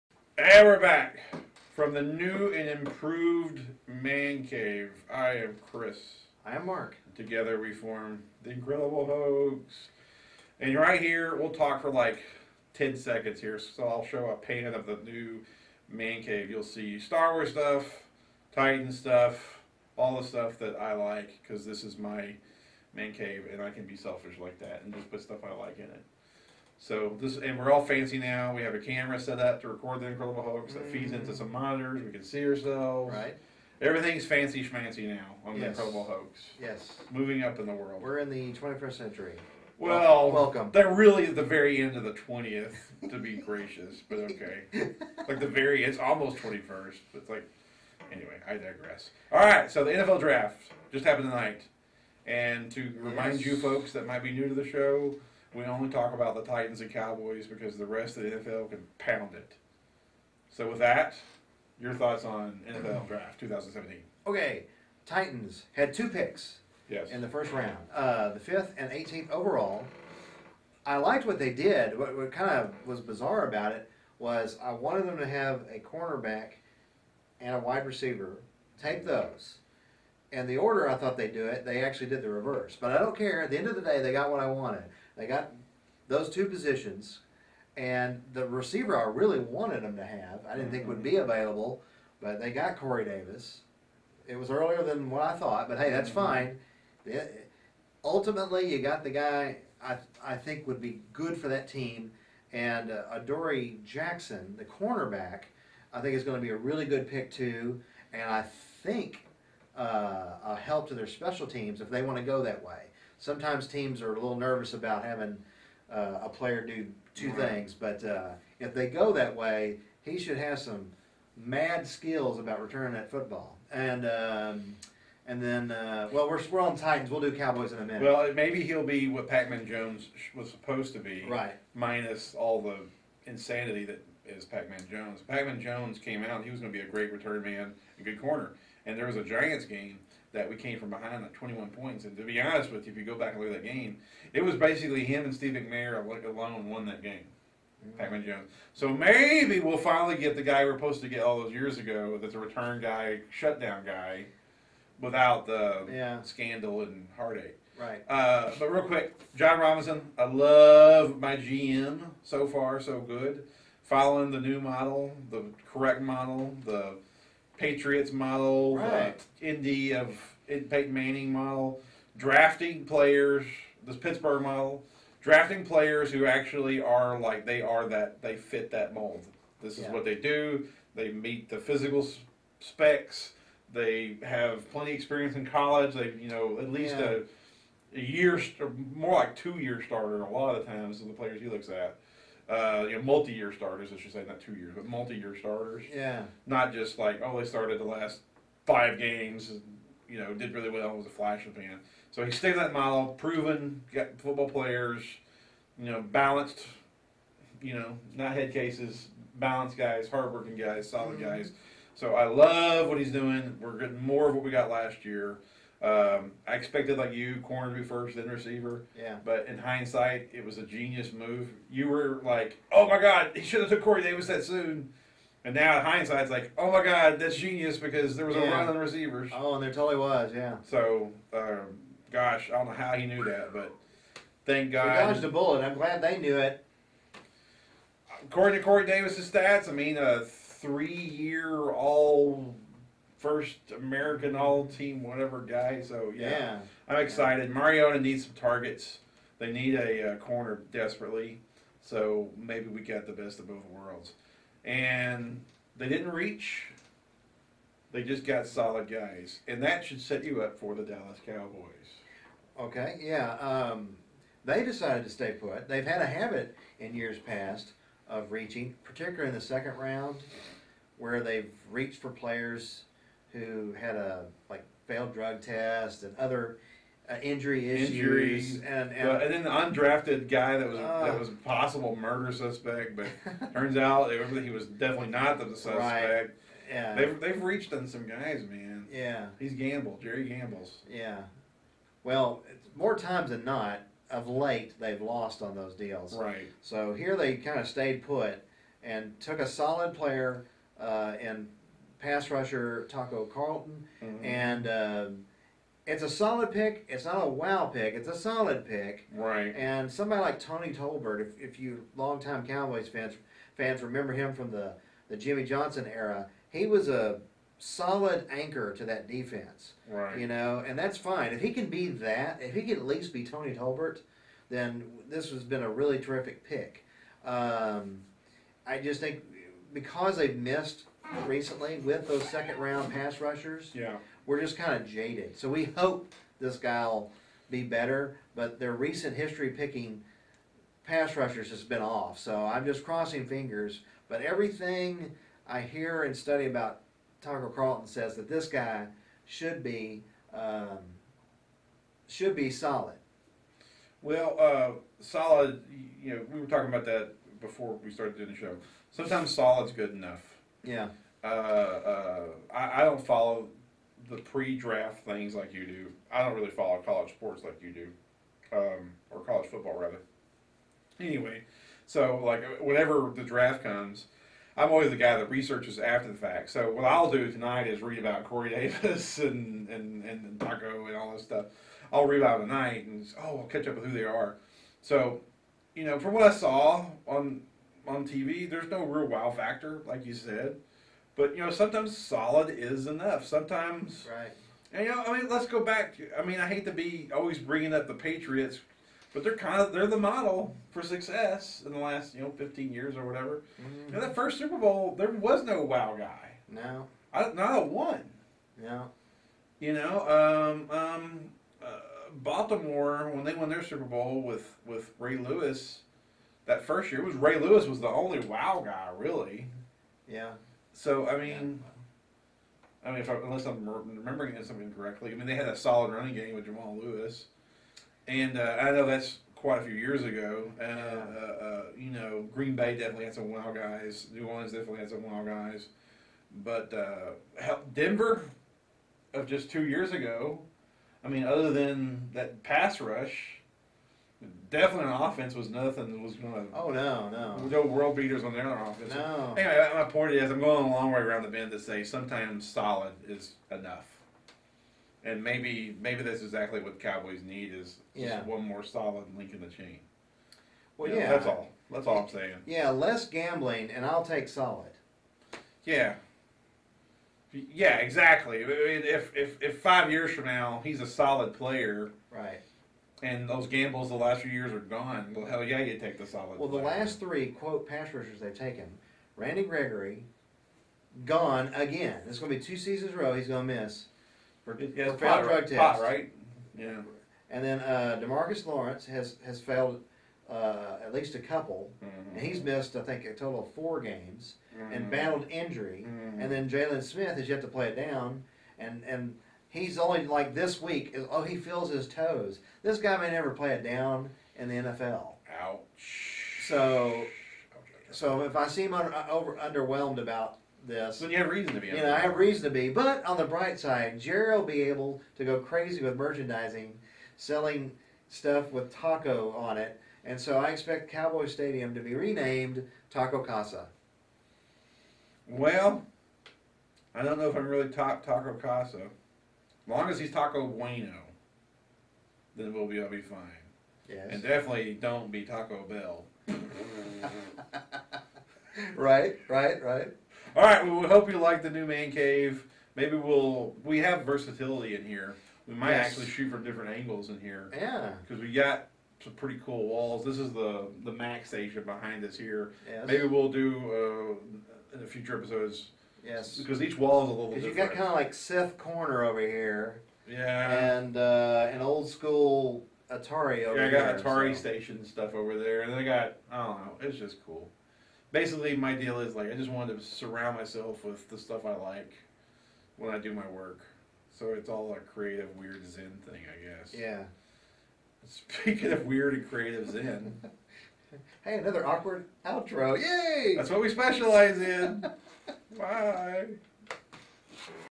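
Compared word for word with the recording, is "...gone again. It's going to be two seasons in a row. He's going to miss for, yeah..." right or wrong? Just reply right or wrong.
right.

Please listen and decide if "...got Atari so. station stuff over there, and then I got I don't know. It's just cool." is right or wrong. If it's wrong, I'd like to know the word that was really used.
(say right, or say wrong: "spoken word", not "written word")
right.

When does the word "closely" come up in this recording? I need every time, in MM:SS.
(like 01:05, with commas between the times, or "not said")
not said.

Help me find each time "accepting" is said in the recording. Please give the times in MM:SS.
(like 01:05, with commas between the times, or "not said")
not said.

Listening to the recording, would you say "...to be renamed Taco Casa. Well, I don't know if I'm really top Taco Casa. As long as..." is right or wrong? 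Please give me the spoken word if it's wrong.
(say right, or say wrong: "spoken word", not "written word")
right.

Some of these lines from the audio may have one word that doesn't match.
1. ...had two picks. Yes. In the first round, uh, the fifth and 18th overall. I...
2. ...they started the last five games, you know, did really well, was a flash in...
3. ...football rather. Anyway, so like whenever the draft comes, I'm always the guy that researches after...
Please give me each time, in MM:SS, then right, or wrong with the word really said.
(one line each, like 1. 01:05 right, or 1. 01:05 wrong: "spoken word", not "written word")
1. 01:05 right
2. 03:17 right
3. 06:09 right.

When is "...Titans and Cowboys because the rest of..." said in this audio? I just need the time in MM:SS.
00:56.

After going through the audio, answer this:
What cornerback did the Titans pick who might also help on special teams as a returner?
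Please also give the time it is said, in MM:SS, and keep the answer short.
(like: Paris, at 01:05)
Adoree Jackson, at 01:43.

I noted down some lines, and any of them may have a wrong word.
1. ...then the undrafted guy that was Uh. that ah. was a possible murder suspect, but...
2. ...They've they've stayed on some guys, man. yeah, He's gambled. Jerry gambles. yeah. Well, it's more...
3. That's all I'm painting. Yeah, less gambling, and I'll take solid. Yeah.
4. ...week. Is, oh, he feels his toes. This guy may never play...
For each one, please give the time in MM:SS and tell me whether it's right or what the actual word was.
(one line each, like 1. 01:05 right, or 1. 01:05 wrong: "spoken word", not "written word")
1. 04:39 right
2. 04:46 wrong: "reached", not "stayed"
3. 07:41 wrong: "saying", not "painting"
4. 08:20 right.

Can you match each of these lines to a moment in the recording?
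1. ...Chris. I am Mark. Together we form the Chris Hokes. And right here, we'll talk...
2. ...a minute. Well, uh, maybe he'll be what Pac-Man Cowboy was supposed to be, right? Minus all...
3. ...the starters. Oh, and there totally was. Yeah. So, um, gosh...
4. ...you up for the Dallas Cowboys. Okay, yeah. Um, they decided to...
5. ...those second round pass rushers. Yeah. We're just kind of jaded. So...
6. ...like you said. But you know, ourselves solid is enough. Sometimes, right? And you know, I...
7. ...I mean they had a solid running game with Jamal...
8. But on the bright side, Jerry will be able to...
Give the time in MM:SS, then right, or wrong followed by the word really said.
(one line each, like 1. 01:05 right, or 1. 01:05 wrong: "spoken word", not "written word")
1. 00:05 wrong: "Incredible", not "Chris"
2. 02:07 wrong: "Jones", not "Cowboy"
3. 03:48 wrong: "receivers", not "starters"
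4. 04:20 right
5. 05:32 right
6. 06:29 wrong: "sometimes", not "ourselves"
7. 07:05 right
8. 08:32 right.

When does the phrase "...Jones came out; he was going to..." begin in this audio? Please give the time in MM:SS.
02:15.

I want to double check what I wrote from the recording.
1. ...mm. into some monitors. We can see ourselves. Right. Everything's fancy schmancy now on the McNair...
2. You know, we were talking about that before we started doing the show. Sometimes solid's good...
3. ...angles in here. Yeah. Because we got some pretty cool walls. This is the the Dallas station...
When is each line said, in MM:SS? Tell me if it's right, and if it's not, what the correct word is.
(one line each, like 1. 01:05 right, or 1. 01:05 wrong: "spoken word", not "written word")
1. 00:31 wrong: "Incredible", not "McNair"
2. 05:56 right
3. 09:06 wrong: "Max", not "Dallas".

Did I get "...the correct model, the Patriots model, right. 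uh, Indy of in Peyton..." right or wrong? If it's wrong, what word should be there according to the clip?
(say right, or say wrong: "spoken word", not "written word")
right.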